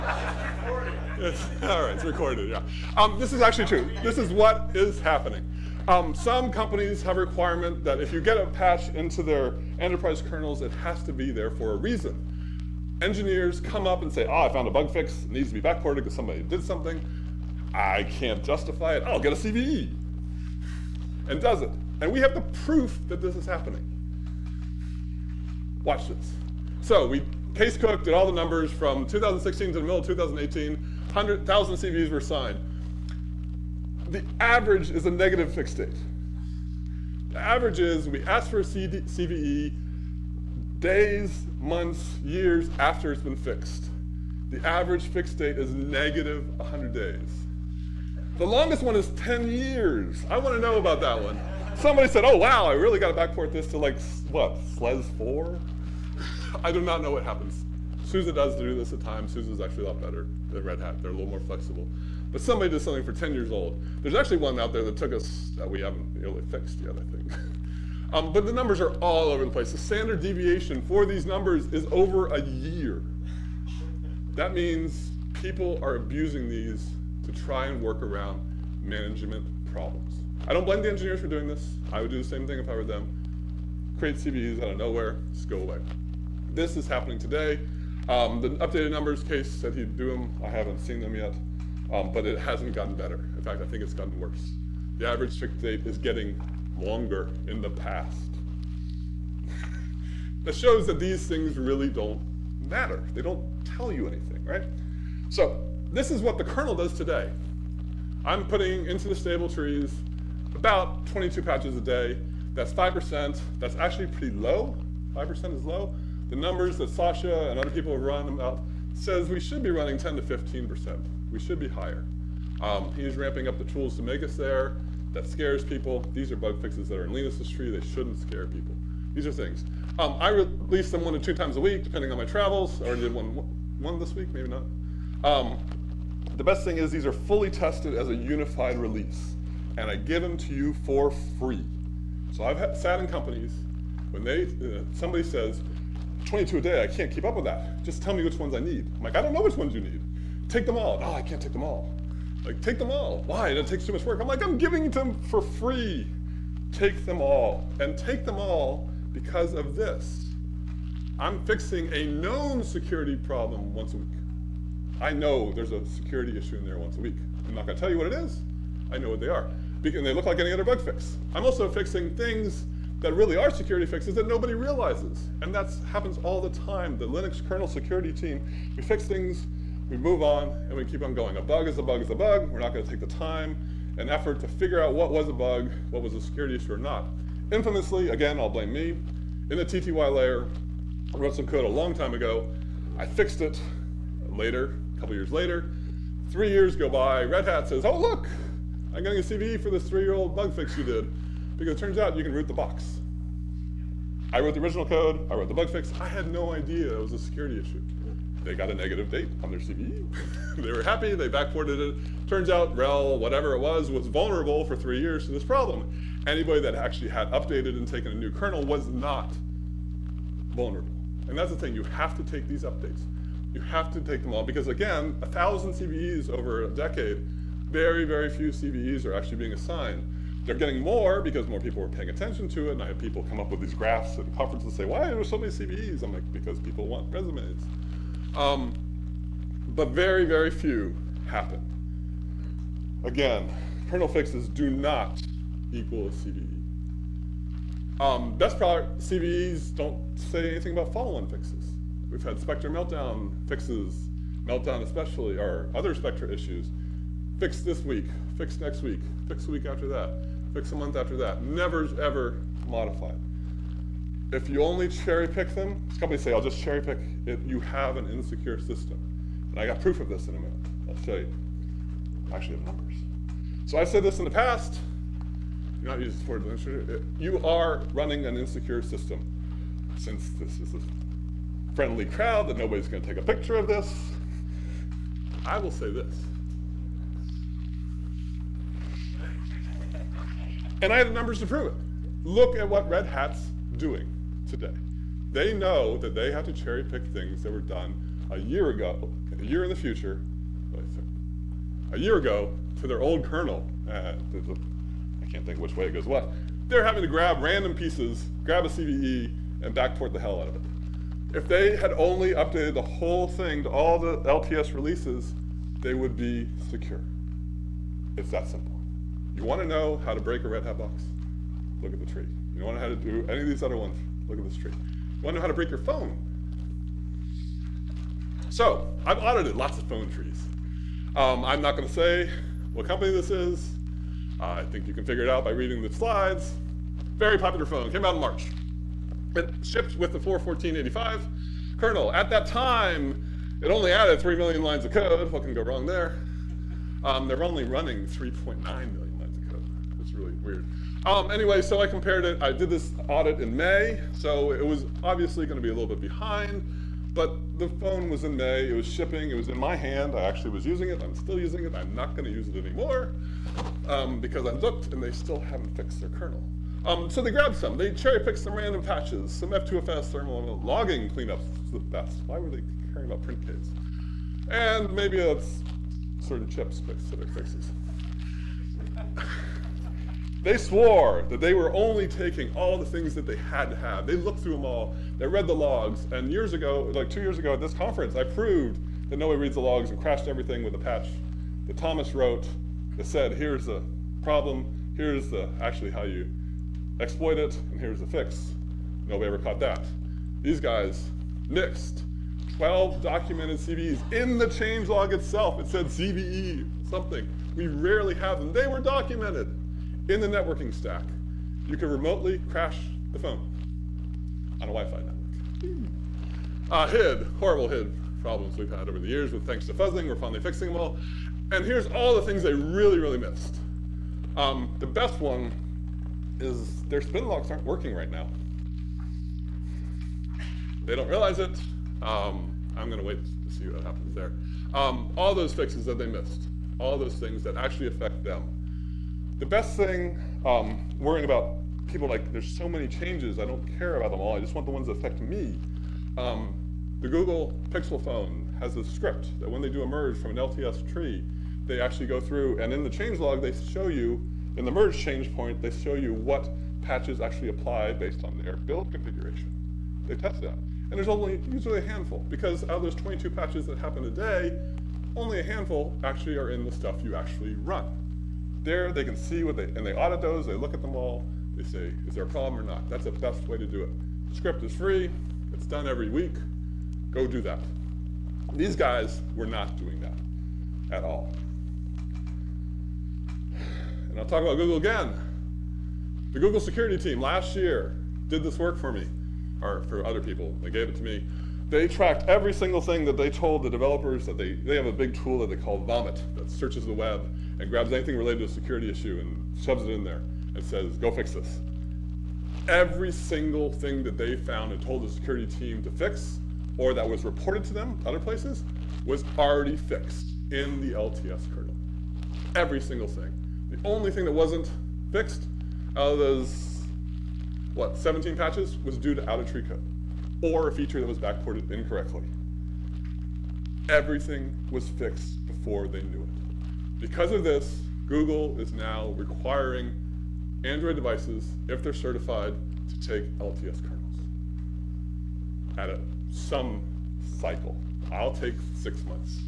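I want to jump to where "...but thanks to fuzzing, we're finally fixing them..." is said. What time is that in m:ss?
6:59.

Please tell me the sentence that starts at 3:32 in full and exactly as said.
Turns out RHEL, whatever it was, was vulnerable for three years to this problem.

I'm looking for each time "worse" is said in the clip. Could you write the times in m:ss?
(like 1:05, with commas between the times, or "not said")
1:34.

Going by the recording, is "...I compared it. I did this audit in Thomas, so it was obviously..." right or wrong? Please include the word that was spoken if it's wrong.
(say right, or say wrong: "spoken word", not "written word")
wrong: "May", not "Thomas".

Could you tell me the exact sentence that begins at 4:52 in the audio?
Look at what Red Hat's doing today.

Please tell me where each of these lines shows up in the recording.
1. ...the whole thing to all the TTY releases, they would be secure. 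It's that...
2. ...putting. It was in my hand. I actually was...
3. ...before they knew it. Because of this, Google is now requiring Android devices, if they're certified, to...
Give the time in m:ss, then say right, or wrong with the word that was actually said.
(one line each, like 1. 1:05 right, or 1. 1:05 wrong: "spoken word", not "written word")
1. 5:12 wrong: "LTS", not "TTY"
2. 5:58 wrong: "shipping", not "putting"
3. 8:45 right.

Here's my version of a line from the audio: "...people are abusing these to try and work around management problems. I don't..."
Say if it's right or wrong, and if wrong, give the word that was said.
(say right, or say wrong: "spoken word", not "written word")
right.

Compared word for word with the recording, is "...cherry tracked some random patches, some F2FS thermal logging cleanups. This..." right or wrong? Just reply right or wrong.
wrong.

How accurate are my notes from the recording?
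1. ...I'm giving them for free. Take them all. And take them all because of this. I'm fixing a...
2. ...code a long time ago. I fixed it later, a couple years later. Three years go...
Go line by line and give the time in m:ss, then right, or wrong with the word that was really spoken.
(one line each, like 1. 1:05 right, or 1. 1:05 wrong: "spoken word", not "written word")
1. 2:34 right
2. 3:11 right.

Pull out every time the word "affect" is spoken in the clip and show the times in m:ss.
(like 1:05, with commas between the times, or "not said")
7:17, 7:24.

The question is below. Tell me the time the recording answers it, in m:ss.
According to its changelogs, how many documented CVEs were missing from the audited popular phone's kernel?
6:42.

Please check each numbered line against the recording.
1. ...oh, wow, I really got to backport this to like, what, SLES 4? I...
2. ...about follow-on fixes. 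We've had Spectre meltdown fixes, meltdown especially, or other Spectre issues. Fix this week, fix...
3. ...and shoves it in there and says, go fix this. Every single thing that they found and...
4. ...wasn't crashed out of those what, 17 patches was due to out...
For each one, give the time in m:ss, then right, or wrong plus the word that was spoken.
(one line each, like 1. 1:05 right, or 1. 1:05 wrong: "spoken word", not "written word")
1. 0:52 right
2. 4:10 right
3. 8:19 right
4. 8:34 wrong: "fixed", not "crashed".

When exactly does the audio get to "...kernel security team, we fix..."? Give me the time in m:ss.
2:57.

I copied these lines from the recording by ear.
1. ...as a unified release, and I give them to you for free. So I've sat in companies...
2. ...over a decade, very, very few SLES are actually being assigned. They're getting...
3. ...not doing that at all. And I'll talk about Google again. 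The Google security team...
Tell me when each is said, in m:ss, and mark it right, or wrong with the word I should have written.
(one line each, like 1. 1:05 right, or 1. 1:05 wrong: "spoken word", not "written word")
1. 2:17 right
2. 3:46 wrong: "CVEs", not "SLES"
3. 7:59 right.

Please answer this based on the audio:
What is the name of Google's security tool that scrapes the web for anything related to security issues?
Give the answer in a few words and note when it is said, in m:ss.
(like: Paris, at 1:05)
Vomit, at 8:15.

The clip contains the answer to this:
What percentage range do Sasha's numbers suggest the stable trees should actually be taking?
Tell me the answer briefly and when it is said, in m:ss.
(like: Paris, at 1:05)
10 to 15%, at 1:59.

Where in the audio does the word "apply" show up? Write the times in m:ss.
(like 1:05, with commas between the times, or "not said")
7:37.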